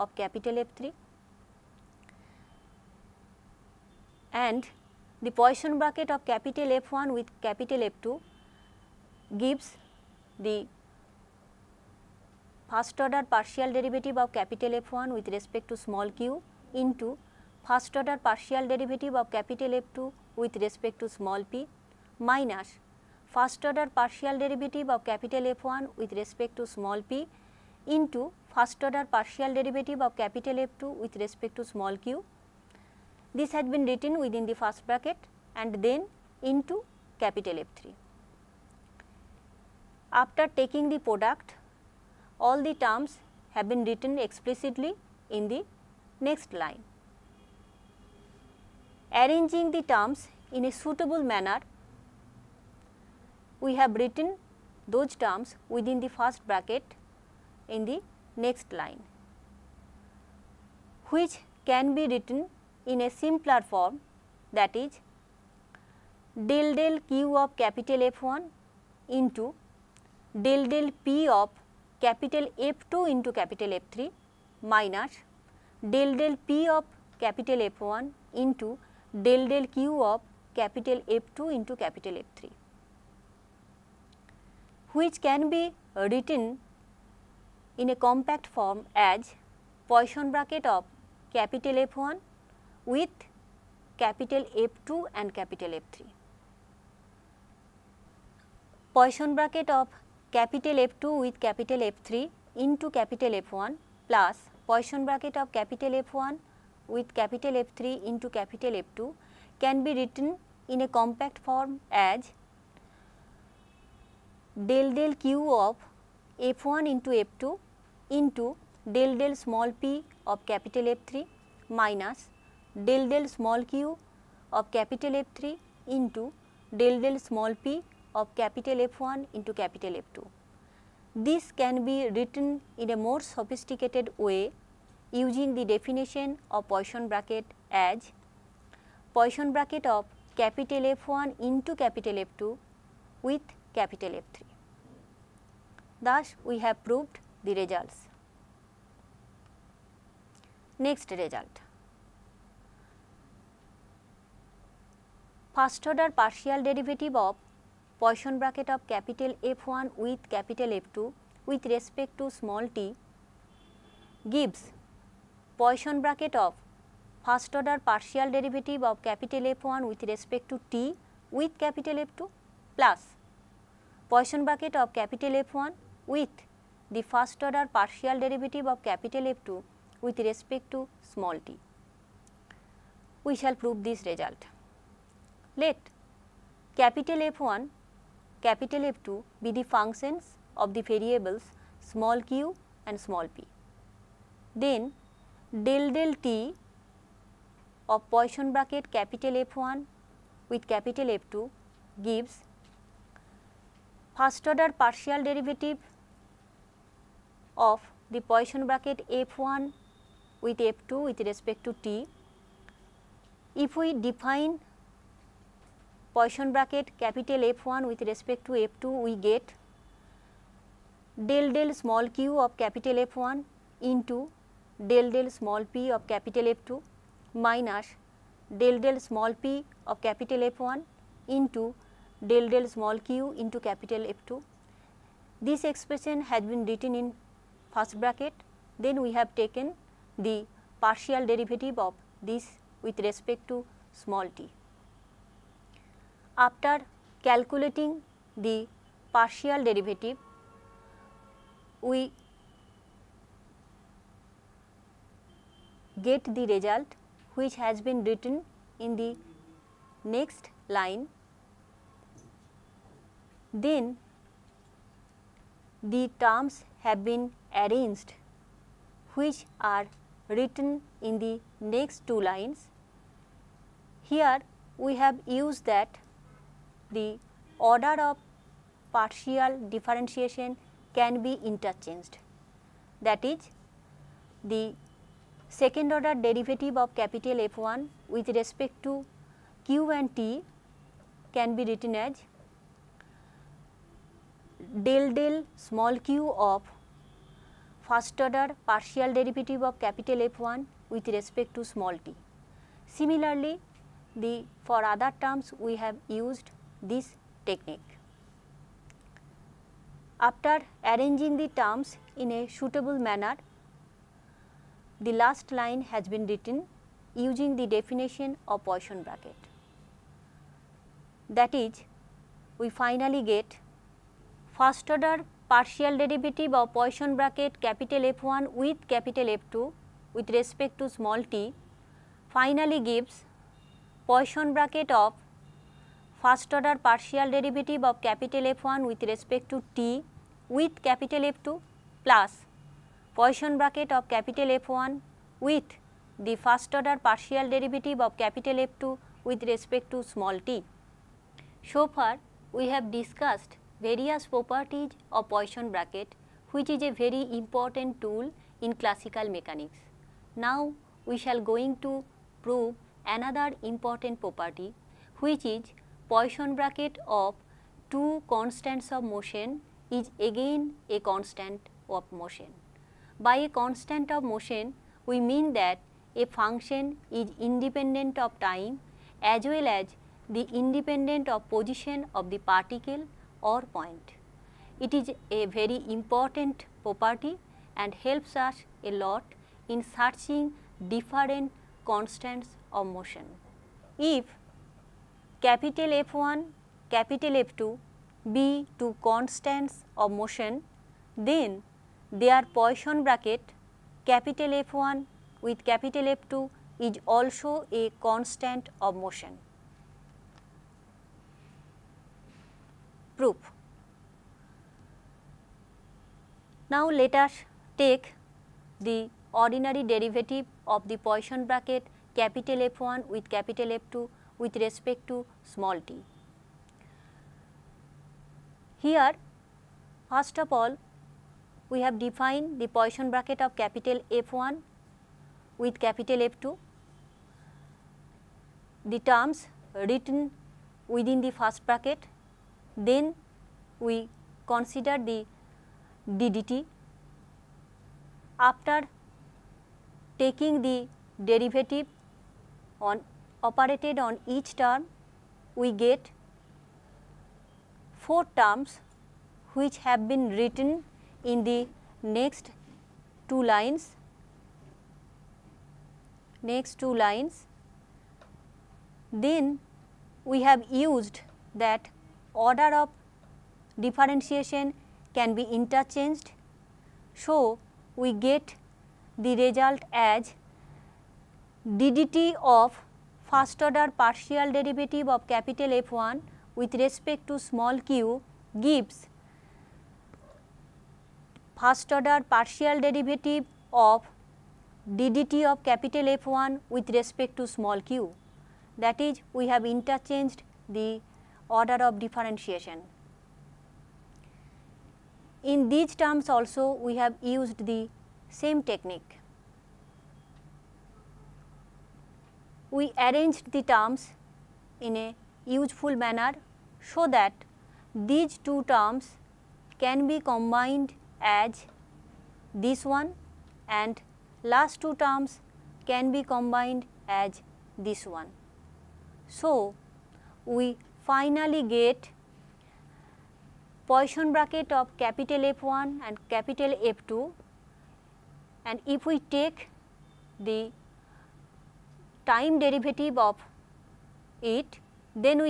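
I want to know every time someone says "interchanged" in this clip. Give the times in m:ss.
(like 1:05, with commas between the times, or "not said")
4:41, 7:55, 8:19.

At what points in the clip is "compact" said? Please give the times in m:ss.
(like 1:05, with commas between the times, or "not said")
1:27, 1:50.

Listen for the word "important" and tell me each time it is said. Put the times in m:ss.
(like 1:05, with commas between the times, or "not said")
5:57, 6:03, 6:25.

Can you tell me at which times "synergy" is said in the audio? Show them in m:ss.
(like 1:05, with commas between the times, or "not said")
not said.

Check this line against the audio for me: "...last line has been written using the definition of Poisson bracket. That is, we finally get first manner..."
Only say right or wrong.
wrong.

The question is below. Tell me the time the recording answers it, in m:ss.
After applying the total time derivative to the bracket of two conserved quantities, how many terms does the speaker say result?
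7:38.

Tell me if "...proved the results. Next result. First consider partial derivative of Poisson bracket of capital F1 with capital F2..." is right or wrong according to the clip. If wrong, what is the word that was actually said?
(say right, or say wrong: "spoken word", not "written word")
wrong: "order", not "consider".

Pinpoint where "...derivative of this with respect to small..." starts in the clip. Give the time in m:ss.
4:01.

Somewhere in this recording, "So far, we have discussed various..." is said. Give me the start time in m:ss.
5:51.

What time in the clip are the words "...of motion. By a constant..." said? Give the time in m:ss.
6:11.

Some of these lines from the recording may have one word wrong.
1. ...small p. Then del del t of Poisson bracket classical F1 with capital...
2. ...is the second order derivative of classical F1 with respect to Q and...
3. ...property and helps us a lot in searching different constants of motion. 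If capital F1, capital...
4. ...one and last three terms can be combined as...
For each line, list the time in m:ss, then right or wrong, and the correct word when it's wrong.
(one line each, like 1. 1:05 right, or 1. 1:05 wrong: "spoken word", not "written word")
1. 3:12 wrong: "capital", not "classical"
2. 4:43 wrong: "capital", not "classical"
3. 6:26 right
4. 8:42 wrong: "two", not "three".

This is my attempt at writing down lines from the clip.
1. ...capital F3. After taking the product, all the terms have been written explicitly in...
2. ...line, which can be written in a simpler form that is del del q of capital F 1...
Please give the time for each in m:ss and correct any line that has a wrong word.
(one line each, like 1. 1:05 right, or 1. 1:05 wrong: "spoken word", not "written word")
1. 0:37 right
2. 0:58 right.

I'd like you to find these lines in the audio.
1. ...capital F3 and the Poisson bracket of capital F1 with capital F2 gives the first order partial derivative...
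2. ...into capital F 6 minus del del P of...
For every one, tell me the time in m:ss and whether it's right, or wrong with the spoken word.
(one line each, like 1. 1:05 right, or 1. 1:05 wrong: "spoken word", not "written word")
1. 0:00 right
2. 1:13 wrong: "3", not "6".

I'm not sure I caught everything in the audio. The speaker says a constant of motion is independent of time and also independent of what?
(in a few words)
position of the particle.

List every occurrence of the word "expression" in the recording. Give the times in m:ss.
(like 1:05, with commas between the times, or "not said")
3:55.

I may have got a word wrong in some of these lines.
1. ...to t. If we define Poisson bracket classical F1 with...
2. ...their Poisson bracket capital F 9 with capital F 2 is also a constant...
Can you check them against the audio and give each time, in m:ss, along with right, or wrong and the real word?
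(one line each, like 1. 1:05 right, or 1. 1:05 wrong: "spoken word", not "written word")
1. 3:31 wrong: "capital", not "classical"
2. 6:42 wrong: "1", not "9".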